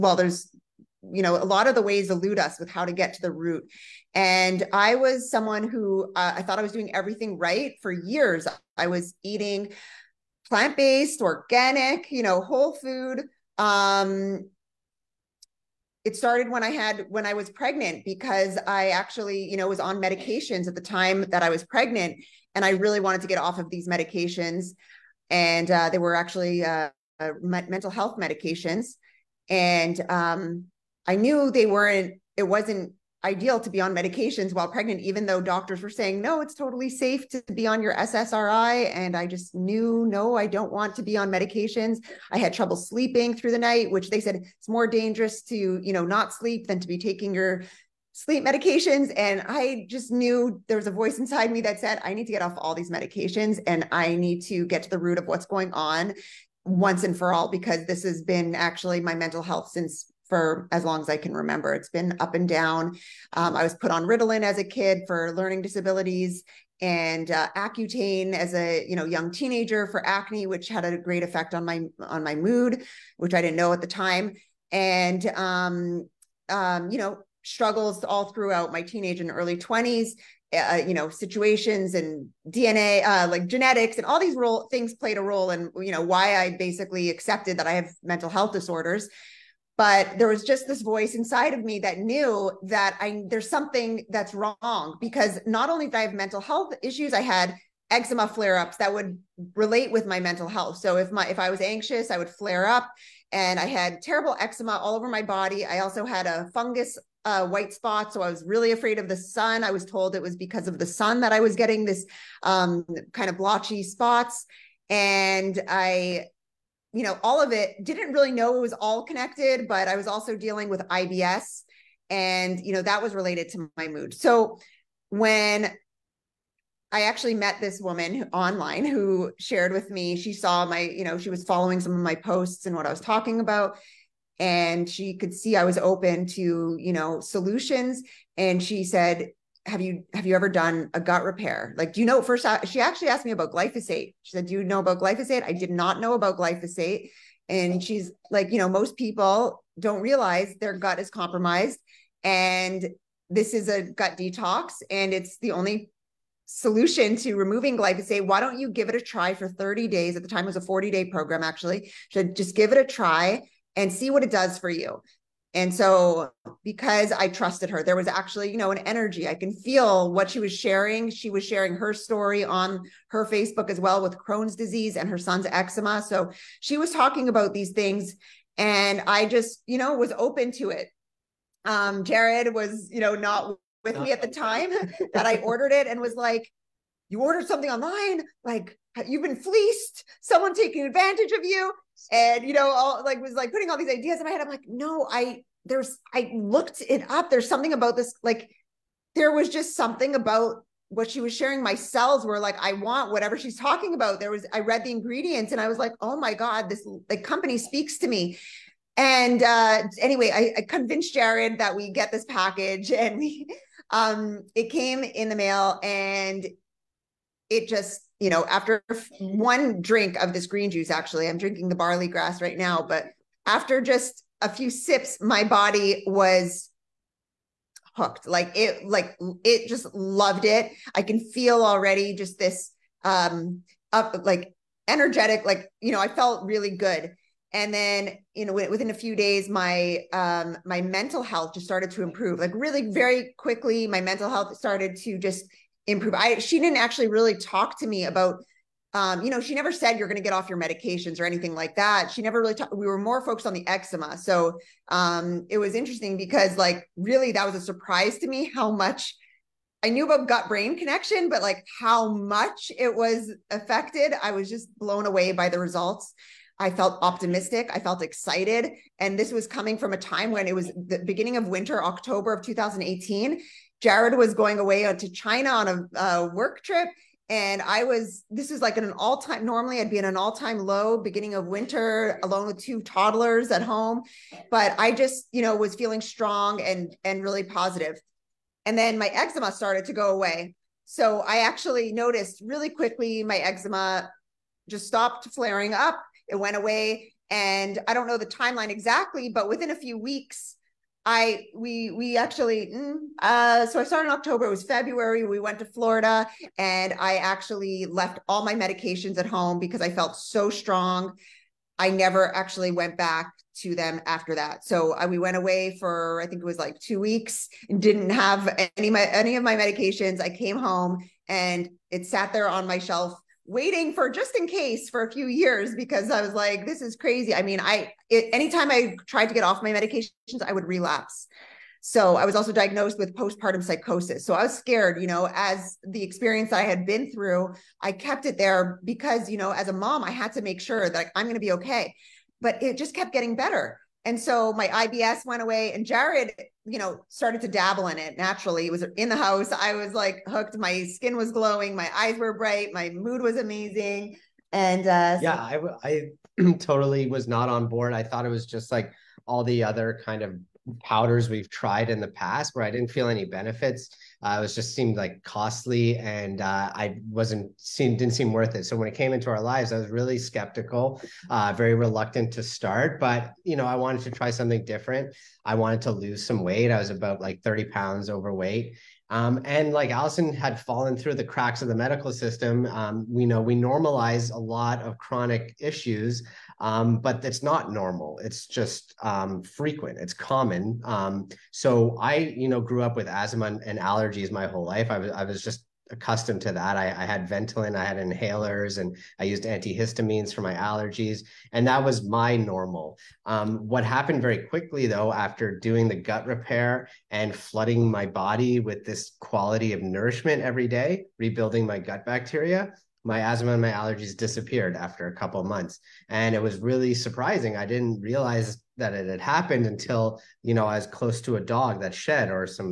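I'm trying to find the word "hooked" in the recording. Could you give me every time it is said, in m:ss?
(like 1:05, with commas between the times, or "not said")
3:47, 5:50.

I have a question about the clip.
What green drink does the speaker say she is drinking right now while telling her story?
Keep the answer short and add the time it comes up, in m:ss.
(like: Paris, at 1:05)
barley grass, at 3:41.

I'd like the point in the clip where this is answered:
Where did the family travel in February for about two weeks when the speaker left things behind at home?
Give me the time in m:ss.
5:05.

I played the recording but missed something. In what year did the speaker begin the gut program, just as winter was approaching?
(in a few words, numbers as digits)
2018.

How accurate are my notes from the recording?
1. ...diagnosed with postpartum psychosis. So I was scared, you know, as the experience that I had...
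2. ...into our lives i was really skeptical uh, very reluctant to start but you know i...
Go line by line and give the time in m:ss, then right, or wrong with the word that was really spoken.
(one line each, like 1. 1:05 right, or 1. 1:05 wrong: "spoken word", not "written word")
1. 5:32 right
2. 6:09 right.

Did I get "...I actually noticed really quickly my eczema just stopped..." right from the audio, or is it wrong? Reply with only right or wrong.
right.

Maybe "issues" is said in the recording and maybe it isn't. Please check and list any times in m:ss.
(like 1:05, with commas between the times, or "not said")
1:36, 6:25.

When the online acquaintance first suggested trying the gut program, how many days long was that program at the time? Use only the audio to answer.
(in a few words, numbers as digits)
40 days.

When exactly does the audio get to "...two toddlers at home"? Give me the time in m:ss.
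4:42.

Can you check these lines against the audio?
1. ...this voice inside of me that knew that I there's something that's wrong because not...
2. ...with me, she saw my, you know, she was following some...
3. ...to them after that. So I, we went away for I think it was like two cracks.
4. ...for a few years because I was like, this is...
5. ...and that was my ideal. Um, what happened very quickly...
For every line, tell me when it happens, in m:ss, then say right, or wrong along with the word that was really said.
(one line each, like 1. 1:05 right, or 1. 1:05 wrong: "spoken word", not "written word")
1. 1:30 right
2. 2:09 right
3. 5:13 wrong: "weeks", not "cracks"
4. 5:24 right
5. 6:41 wrong: "normal", not "ideal".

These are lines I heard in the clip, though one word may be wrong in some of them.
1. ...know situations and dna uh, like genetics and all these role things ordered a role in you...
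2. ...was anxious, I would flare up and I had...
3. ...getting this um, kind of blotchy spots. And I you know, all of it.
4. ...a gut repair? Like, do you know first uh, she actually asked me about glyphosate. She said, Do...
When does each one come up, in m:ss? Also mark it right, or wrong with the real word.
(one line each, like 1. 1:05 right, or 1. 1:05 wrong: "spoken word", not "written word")
1. 1:20 wrong: "played", not "ordered"
2. 1:41 right
3. 1:51 right
4. 2:20 right.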